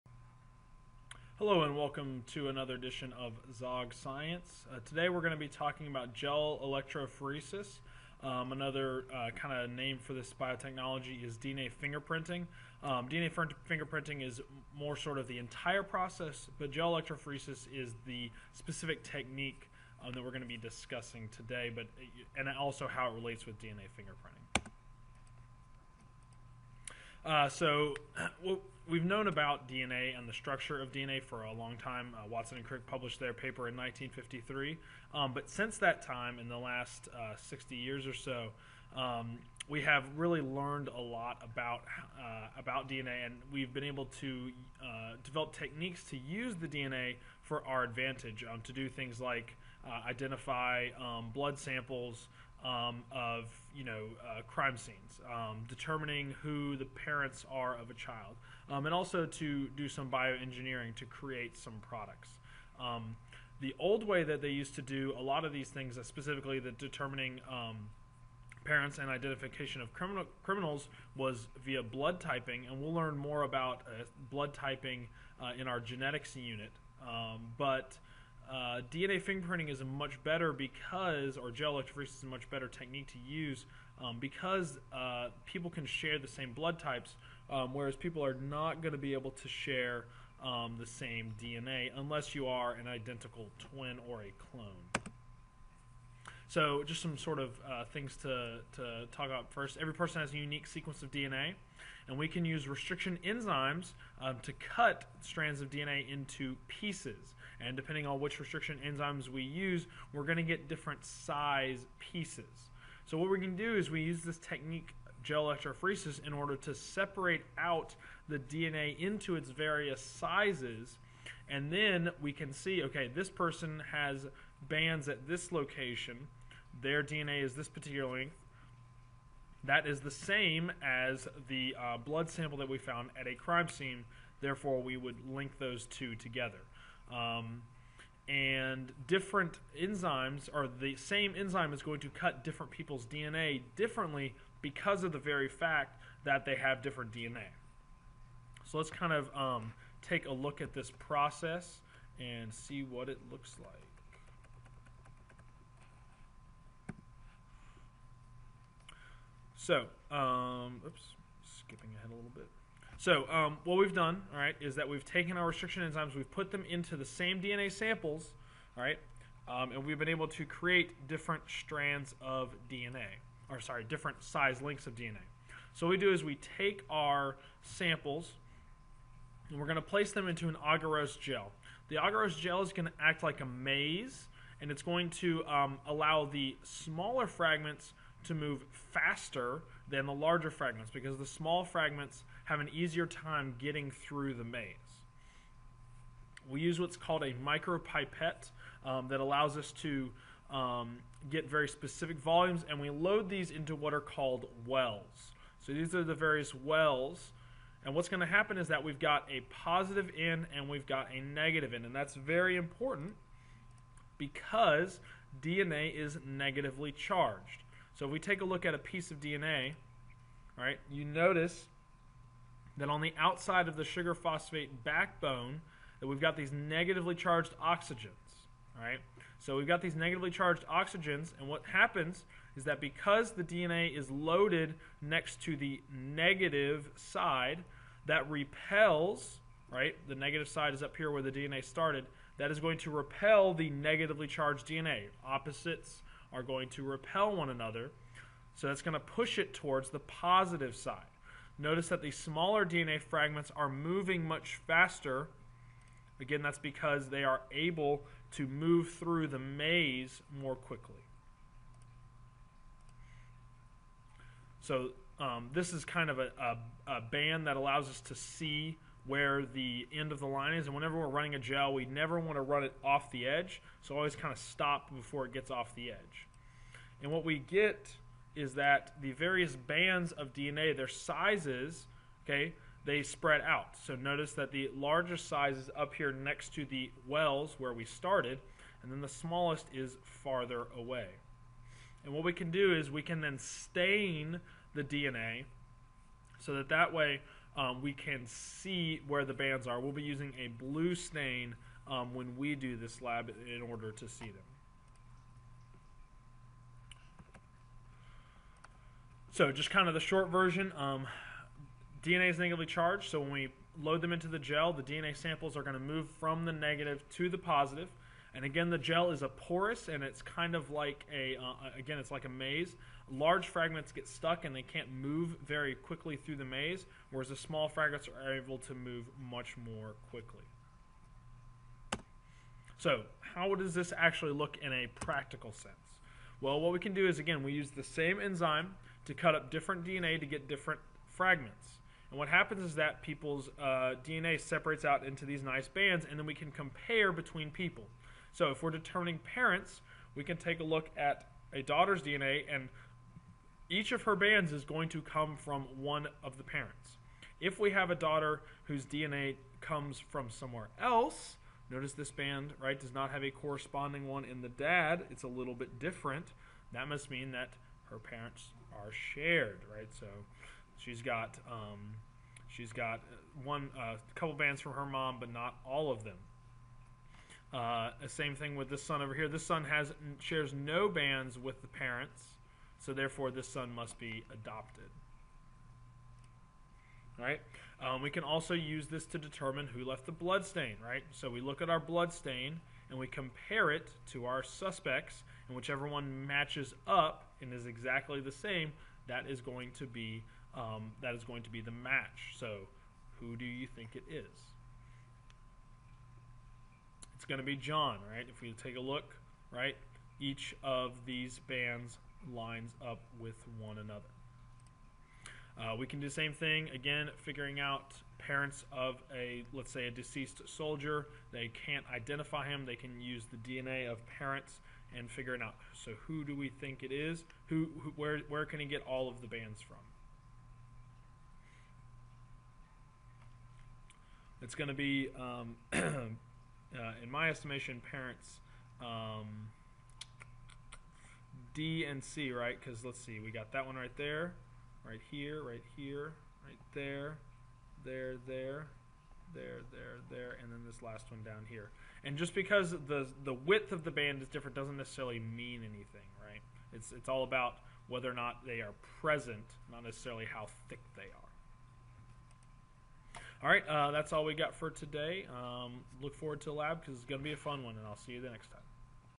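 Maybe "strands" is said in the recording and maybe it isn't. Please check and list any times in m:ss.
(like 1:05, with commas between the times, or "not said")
1:45, 2:51.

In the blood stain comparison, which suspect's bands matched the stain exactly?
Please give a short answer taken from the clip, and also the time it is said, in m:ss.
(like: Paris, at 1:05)
John, at 6:47.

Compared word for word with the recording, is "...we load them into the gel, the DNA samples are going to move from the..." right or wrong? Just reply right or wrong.
right.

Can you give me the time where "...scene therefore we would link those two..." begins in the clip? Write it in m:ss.
2:13.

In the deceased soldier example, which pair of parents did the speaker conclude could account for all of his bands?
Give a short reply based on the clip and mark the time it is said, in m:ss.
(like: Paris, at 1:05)
D and C, at 7:21.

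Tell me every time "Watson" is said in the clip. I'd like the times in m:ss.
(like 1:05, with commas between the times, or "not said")
0:32.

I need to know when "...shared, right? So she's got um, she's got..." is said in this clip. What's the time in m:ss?
6:08.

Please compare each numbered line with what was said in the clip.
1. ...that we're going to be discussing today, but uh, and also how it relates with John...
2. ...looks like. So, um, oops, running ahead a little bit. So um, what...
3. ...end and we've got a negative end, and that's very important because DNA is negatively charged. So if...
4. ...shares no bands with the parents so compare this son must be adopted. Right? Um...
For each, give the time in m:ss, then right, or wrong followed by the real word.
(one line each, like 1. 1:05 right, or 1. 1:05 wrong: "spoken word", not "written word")
1. 0:20 wrong: "DNA", not "John"
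2. 2:33 wrong: "skipping", not "running"
3. 3:30 right
4. 6:20 wrong: "therefore", not "compare".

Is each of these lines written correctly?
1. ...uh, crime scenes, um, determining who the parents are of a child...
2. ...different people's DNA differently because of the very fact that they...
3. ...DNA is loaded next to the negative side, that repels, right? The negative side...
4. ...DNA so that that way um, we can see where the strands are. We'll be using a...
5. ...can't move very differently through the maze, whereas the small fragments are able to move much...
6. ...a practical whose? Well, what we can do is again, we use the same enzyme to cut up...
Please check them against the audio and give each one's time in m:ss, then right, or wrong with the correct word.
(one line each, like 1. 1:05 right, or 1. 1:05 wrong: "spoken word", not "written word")
1. 0:54 right
2. 2:22 right
3. 3:53 right
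4. 4:54 wrong: "bands", not "strands"
5. 5:24 wrong: "quickly", not "differently"
6. 5:34 wrong: "sense", not "whose".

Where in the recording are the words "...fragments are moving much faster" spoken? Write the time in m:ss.
4:13.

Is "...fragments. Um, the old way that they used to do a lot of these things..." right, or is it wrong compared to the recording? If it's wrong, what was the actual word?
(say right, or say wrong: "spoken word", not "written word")
wrong: "products", not "fragments".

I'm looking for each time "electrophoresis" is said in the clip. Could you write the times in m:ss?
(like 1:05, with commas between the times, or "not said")
0:06, 0:16, 1:21, 1:55.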